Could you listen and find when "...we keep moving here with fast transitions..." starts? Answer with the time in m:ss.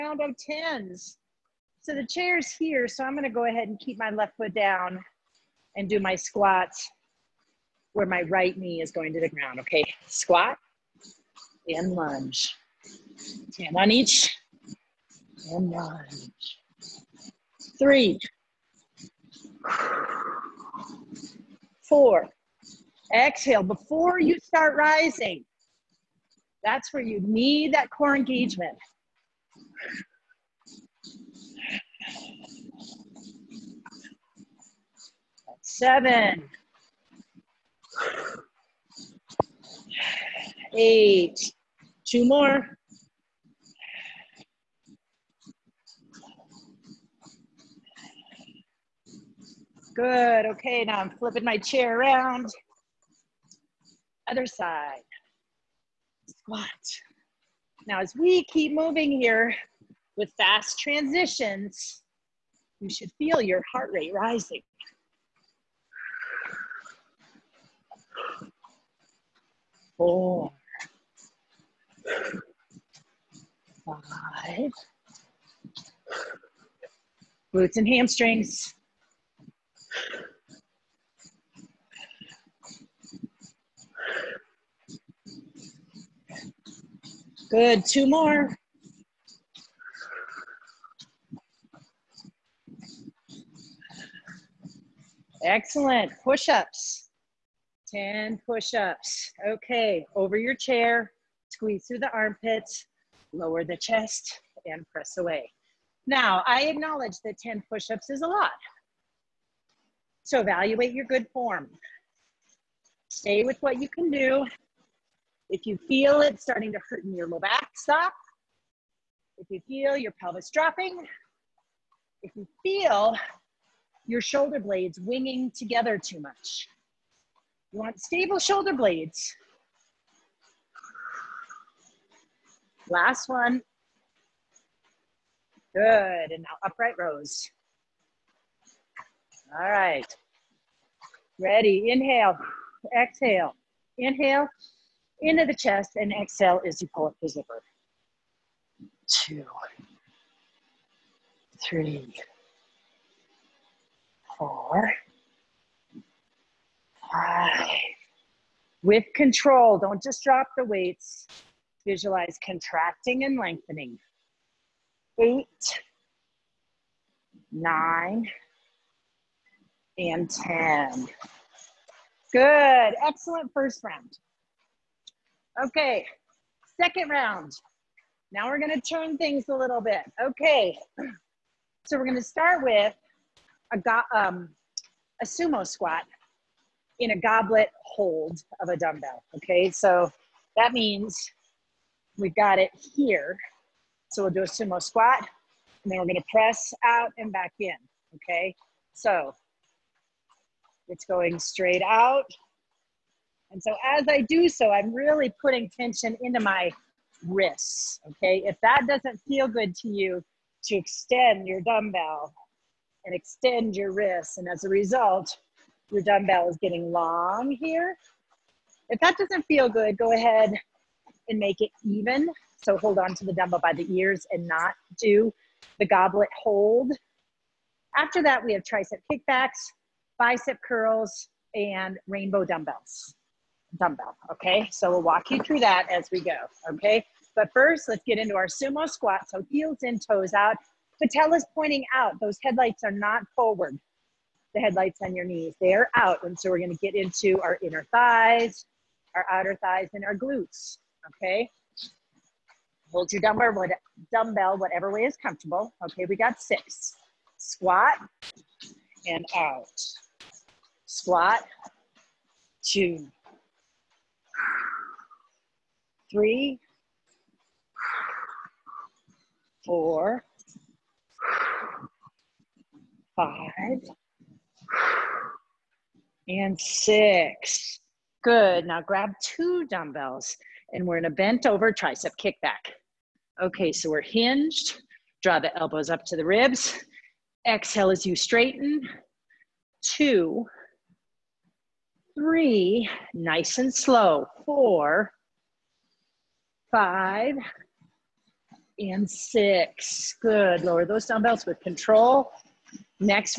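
0:58.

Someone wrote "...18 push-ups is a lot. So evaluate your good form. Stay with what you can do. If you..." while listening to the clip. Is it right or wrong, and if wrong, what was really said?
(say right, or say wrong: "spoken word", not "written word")
wrong: "10", not "18".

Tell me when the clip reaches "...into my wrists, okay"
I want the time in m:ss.
3:26.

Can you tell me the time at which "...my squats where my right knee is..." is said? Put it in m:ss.
0:05.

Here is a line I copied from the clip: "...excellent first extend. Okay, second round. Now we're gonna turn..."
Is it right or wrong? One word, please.
wrong.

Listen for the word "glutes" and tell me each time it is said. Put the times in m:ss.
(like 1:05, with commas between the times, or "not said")
1:17, 4:10.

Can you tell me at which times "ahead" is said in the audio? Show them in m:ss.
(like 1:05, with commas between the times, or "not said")
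0:03, 3:40.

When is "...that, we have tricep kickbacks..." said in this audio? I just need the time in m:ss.
3:48.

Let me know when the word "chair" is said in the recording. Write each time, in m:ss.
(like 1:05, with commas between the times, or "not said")
0:02, 0:51, 1:40.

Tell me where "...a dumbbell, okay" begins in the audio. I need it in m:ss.
3:08.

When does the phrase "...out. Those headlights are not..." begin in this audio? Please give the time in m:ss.
4:01.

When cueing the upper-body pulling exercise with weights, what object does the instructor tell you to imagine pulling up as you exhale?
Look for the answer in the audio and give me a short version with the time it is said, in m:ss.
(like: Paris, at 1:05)
Zipper, at 2:27.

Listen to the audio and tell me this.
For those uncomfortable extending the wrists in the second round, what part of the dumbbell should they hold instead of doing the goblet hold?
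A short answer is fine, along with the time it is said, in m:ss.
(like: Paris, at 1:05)
The ears, at 3:43.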